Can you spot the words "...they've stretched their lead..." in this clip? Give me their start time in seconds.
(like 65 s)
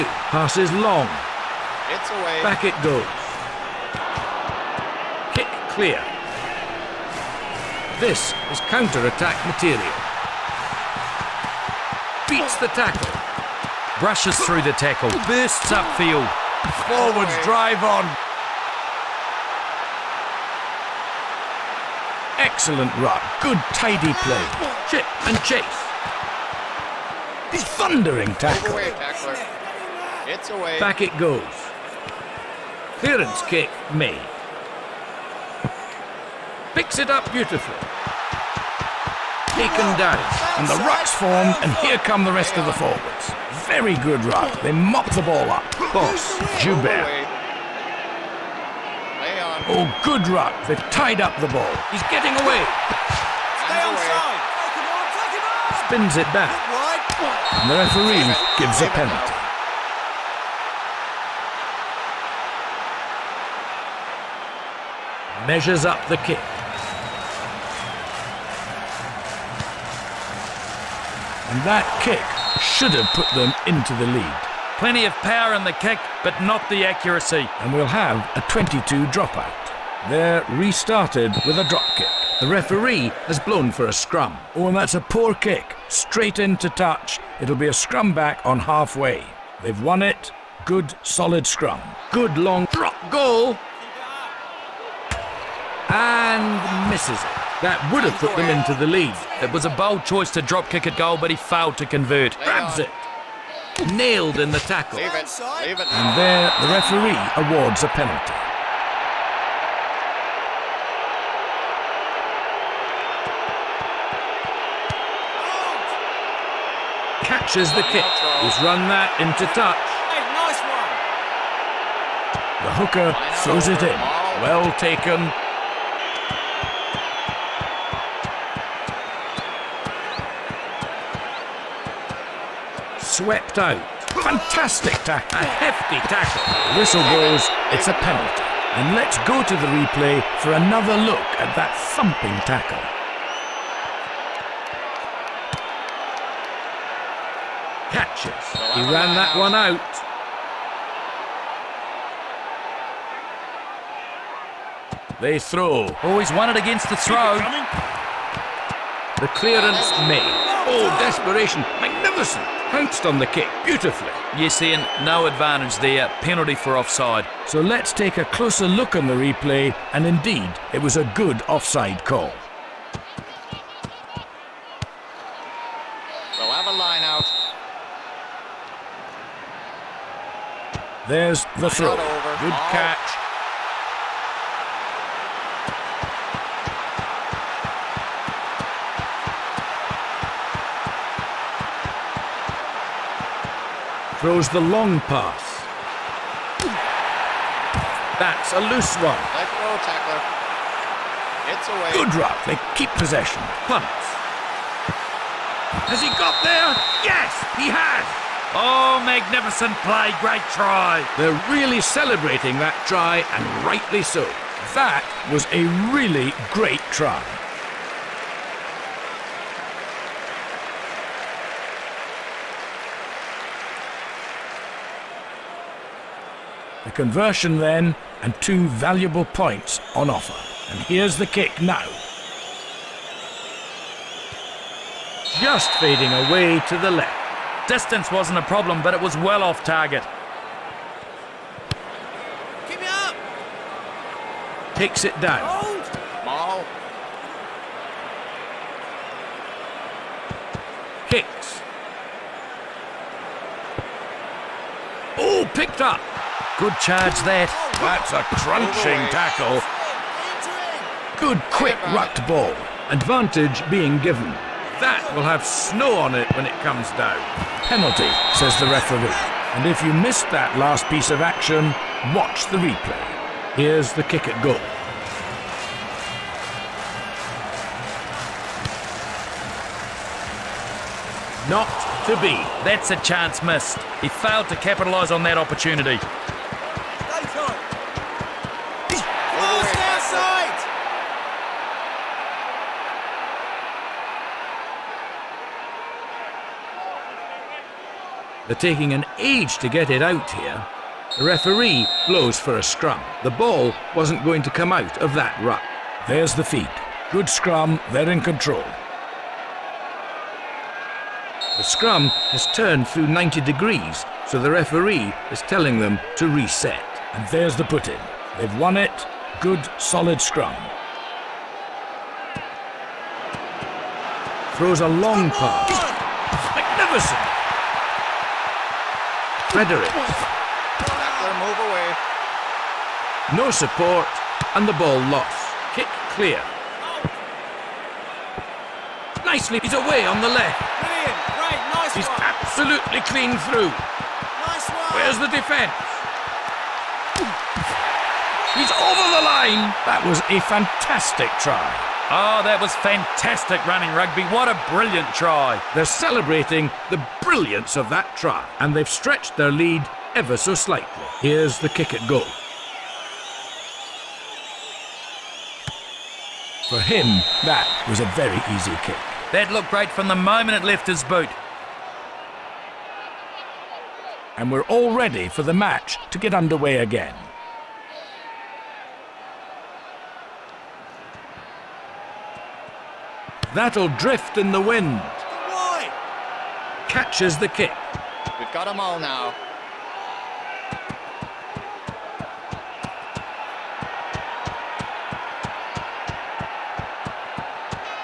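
358 s.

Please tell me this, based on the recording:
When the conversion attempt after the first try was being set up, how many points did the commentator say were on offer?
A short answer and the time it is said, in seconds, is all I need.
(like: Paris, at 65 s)
2, at 228 s.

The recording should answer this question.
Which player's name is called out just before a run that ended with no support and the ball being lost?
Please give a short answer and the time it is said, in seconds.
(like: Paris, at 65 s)
Frederick, at 329 s.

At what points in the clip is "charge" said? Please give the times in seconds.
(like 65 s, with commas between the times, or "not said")
256 s.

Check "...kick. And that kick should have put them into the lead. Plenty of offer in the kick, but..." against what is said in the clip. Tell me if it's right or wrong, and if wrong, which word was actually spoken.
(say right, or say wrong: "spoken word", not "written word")
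wrong: "power", not "offer".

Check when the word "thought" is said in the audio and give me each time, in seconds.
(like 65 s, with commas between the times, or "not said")
not said.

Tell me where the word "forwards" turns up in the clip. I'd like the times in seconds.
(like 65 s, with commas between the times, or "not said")
16 s, 42 s.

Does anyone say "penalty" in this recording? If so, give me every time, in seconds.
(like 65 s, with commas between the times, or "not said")
58 s, 107 s, 138 s, 166 s, 267 s.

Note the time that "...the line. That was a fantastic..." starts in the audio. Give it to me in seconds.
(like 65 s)
349 s.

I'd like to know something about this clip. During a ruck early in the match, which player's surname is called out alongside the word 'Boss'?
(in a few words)
Joubert.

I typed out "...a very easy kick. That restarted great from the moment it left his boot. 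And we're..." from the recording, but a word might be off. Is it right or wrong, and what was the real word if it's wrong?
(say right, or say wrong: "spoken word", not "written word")
wrong: "looked", not "restarted".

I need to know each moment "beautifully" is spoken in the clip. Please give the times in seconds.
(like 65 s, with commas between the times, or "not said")
37 s, 163 s.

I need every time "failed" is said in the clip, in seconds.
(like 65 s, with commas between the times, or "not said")
101 s, 284 s.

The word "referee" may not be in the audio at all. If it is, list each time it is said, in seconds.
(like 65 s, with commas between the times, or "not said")
57 s, 82 s, 106 s, 268 s, 301 s, 314 s.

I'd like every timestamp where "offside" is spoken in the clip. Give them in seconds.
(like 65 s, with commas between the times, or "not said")
166 s, 171 s.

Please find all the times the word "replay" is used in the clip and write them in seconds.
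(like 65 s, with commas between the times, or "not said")
139 s, 169 s, 272 s.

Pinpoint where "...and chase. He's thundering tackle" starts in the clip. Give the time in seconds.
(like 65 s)
25 s.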